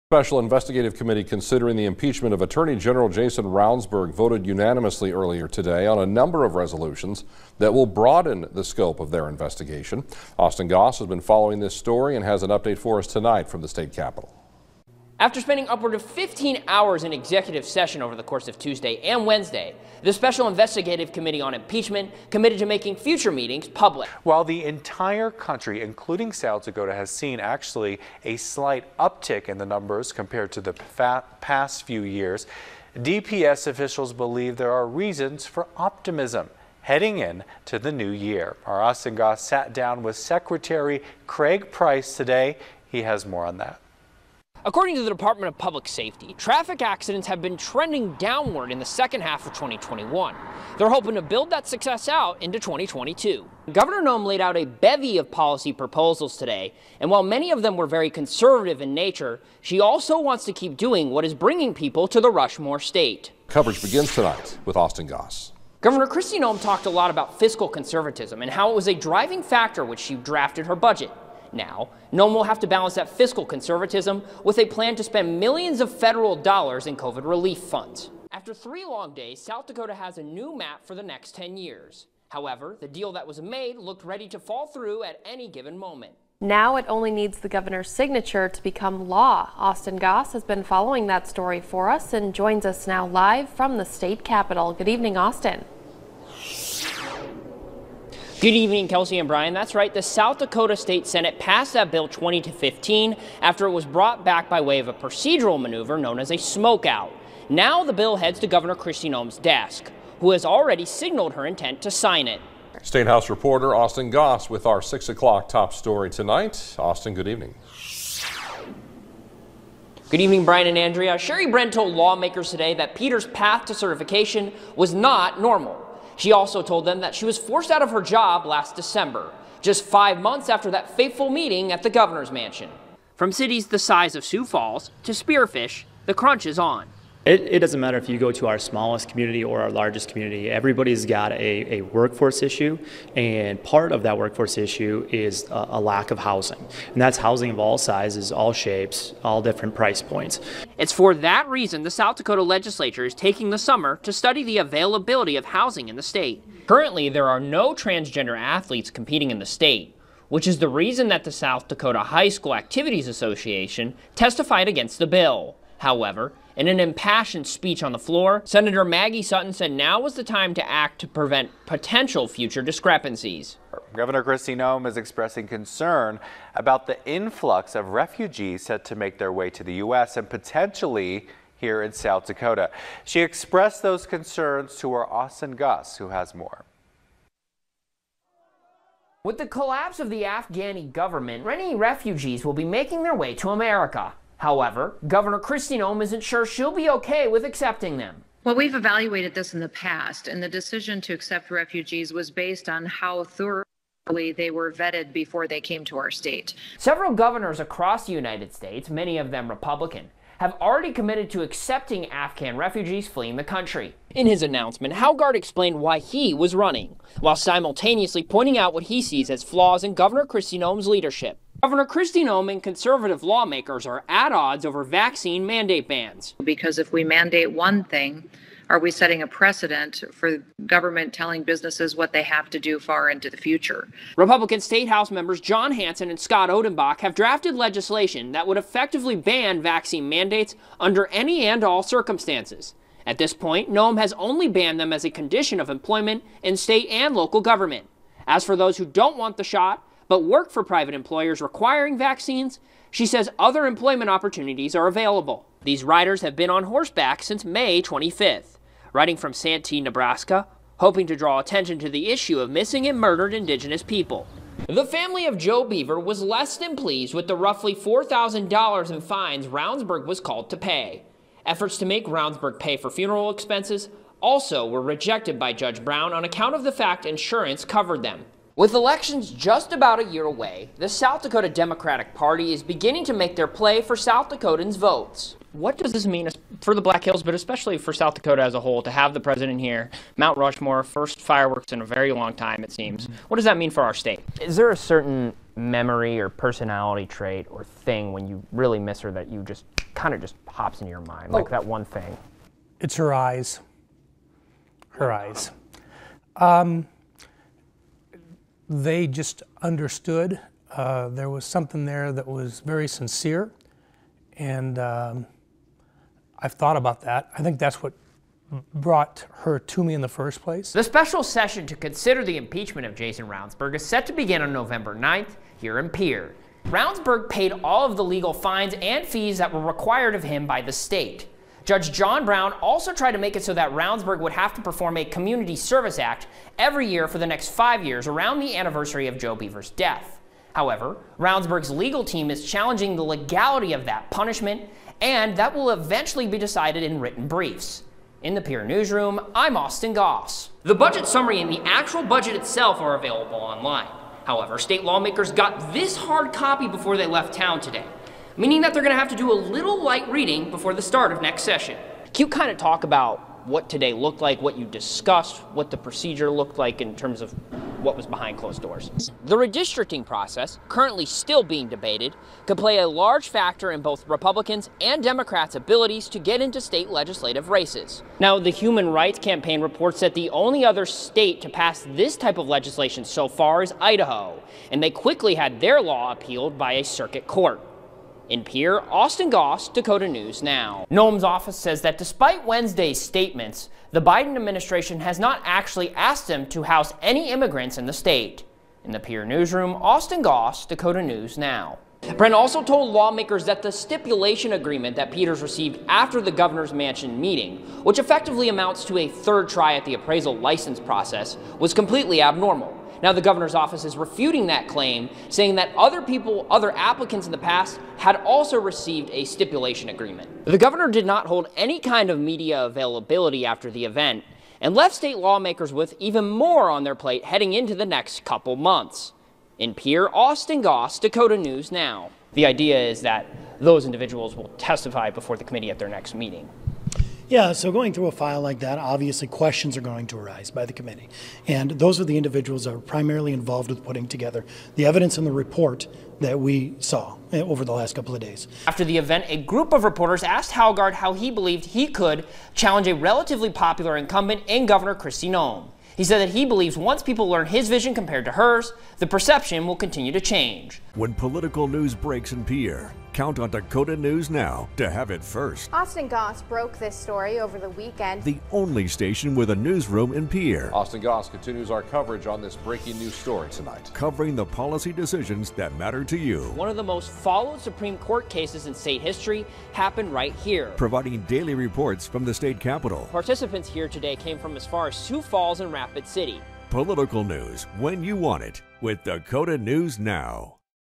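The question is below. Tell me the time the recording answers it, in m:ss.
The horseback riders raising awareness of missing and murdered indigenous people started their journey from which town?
4:19.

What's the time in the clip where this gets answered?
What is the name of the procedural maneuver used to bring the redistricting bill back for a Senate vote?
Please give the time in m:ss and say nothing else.
1:46.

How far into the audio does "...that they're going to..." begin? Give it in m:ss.
5:58.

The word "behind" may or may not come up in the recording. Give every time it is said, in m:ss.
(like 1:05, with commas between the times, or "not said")
6:08.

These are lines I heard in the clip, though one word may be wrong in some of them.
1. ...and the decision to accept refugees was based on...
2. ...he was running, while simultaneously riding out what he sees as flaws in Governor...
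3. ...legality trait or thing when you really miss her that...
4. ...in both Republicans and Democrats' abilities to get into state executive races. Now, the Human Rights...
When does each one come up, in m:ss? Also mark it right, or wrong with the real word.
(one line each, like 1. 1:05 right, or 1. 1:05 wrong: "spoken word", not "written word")
1. 3:20 right
2. 3:35 wrong: "pointing", not "riding"
3. 4:56 wrong: "personality", not "legality"
4. 6:13 wrong: "legislative", not "executive".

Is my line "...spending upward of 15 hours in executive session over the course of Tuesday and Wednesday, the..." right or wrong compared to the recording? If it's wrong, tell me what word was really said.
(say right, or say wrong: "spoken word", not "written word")
right.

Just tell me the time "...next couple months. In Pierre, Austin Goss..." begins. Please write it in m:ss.
7:07.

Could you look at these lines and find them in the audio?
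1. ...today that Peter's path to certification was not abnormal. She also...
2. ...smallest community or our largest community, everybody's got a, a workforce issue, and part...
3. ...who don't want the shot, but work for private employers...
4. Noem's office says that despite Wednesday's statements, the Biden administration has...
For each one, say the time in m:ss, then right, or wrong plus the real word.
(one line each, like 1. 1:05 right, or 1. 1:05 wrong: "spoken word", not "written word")
1. 2:02 wrong: "normal", not "abnormal"
2. 2:18 right
3. 4:08 right
4. 6:30 right.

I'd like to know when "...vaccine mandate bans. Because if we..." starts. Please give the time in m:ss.
3:44.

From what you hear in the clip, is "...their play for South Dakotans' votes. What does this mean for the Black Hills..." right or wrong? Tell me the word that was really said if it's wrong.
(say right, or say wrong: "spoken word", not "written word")
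right.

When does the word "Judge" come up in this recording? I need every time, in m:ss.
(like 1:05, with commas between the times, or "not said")
4:35, 5:31.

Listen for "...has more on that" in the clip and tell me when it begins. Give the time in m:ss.
0:43.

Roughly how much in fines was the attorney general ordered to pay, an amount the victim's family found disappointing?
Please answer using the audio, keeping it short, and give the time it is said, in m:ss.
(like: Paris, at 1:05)
$4,000, at 4:27.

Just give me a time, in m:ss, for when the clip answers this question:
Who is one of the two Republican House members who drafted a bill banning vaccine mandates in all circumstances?
3:55.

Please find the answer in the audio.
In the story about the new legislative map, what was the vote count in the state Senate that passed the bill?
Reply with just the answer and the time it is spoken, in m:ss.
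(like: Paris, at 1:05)
20 to 15, at 1:42.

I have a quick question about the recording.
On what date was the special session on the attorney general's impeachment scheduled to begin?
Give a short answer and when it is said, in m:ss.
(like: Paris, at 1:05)
November 9th, at 5:24.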